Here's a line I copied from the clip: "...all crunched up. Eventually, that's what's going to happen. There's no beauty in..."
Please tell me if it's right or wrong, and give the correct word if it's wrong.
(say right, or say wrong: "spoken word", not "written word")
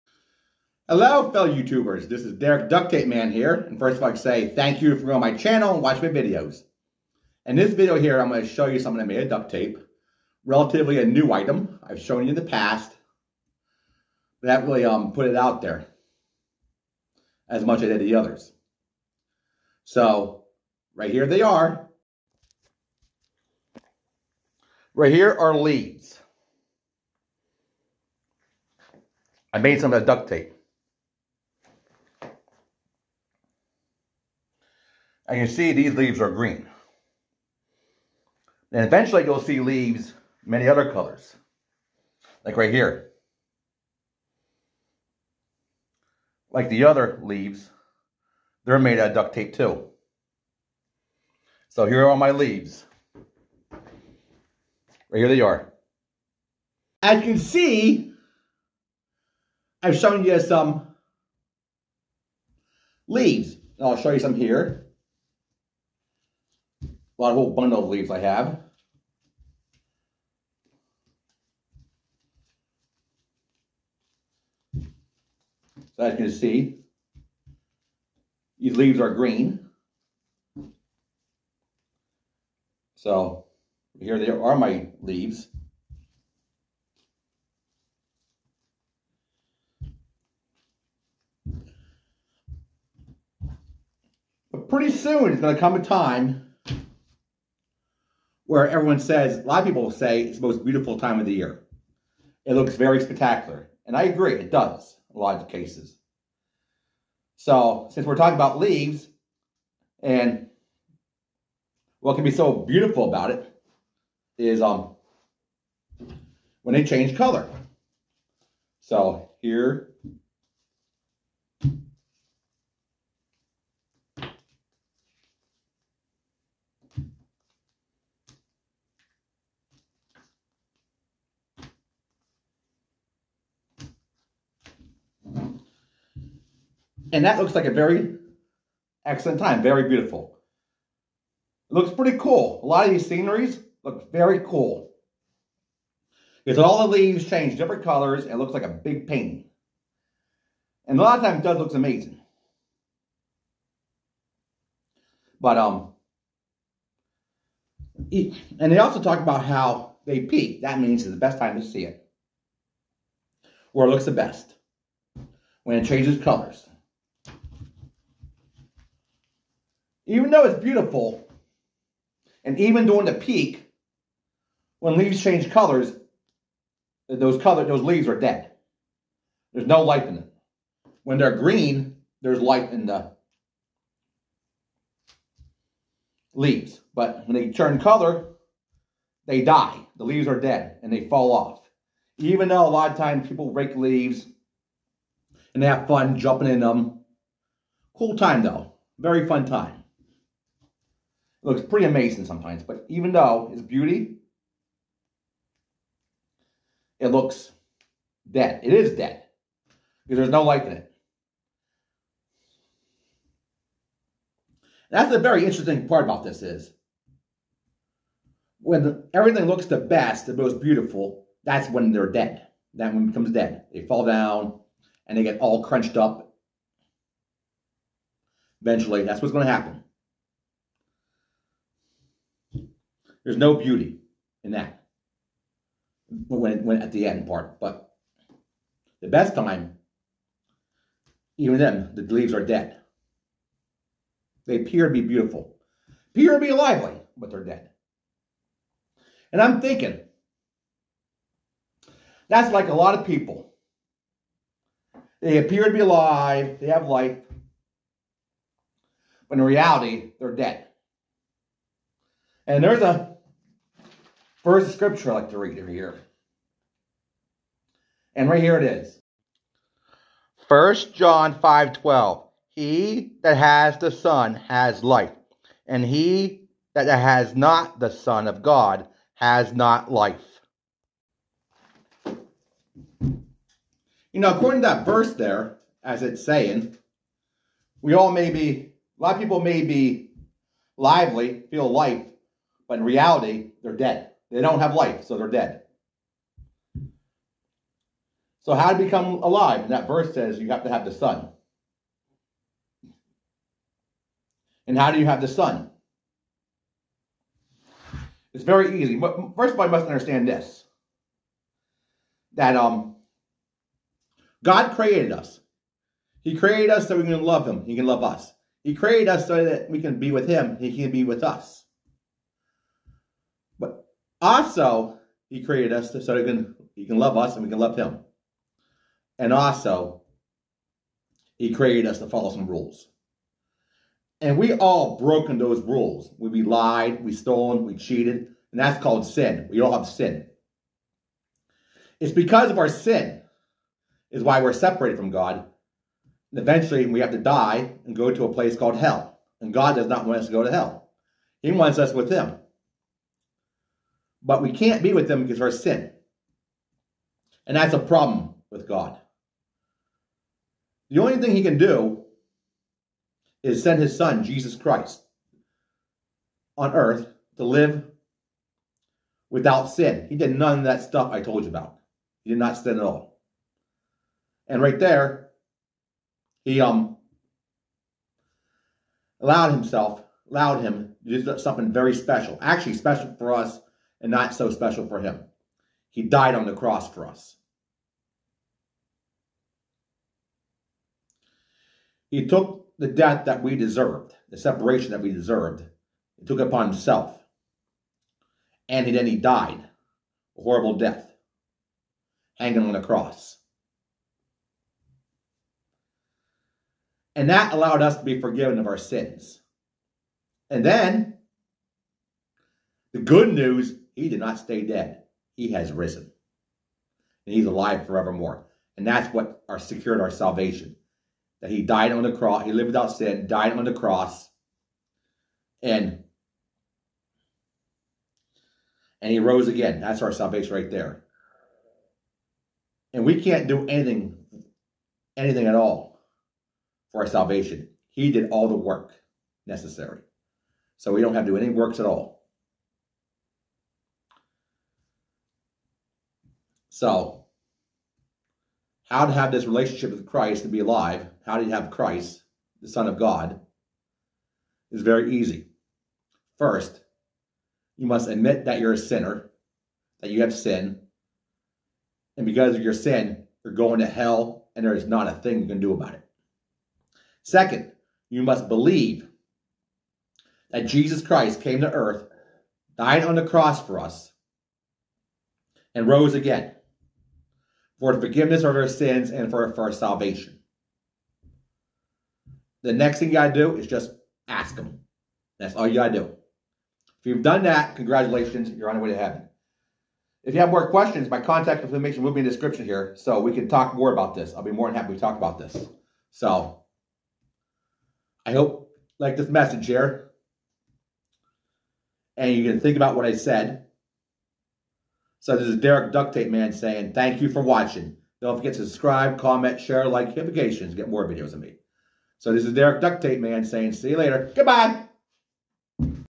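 right.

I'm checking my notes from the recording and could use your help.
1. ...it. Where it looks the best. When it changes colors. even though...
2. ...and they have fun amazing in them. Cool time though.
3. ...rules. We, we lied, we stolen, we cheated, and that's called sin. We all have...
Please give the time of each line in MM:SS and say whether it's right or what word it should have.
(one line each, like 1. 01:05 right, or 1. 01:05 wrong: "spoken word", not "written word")
1. 02:41 right
2. 03:15 wrong: "jumping", not "amazing"
3. 05:35 right.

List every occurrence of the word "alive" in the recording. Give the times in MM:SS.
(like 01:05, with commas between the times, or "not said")
04:15, 04:59, 06:57, 07:30.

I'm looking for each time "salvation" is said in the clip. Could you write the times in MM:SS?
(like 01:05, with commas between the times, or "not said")
07:00, 07:10, 07:17, 07:59.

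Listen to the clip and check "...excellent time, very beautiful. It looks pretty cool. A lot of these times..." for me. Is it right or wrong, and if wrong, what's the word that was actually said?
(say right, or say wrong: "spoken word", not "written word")
wrong: "sceneries", not "times".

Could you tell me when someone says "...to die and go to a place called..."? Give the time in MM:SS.
05:47.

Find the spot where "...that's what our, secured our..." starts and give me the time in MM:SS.
06:58.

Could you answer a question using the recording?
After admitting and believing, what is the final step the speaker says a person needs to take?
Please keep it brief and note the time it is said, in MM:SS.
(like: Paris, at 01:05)
Ask, at 08:03.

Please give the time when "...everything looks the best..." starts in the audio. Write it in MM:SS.
03:39.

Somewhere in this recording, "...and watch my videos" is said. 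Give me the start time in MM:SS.
00:05.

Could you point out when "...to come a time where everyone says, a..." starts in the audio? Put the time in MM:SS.
01:35.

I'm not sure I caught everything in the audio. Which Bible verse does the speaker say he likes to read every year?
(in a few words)
1 John 5:12.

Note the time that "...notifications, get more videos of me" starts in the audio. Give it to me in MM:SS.
08:30.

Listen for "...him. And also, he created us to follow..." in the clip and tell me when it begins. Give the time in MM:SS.
05:27.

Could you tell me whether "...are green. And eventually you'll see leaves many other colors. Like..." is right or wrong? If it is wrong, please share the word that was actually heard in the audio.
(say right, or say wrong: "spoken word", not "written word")
right.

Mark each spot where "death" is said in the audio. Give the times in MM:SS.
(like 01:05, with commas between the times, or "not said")
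06:32, 06:40.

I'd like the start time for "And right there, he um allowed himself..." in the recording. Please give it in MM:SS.
06:14.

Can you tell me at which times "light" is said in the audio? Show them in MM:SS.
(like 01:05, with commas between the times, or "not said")
03:30.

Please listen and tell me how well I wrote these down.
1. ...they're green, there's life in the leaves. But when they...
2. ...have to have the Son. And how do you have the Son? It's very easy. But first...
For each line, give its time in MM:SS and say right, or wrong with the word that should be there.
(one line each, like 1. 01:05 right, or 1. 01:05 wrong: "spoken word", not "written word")
1. 03:01 right
2. 05:00 right.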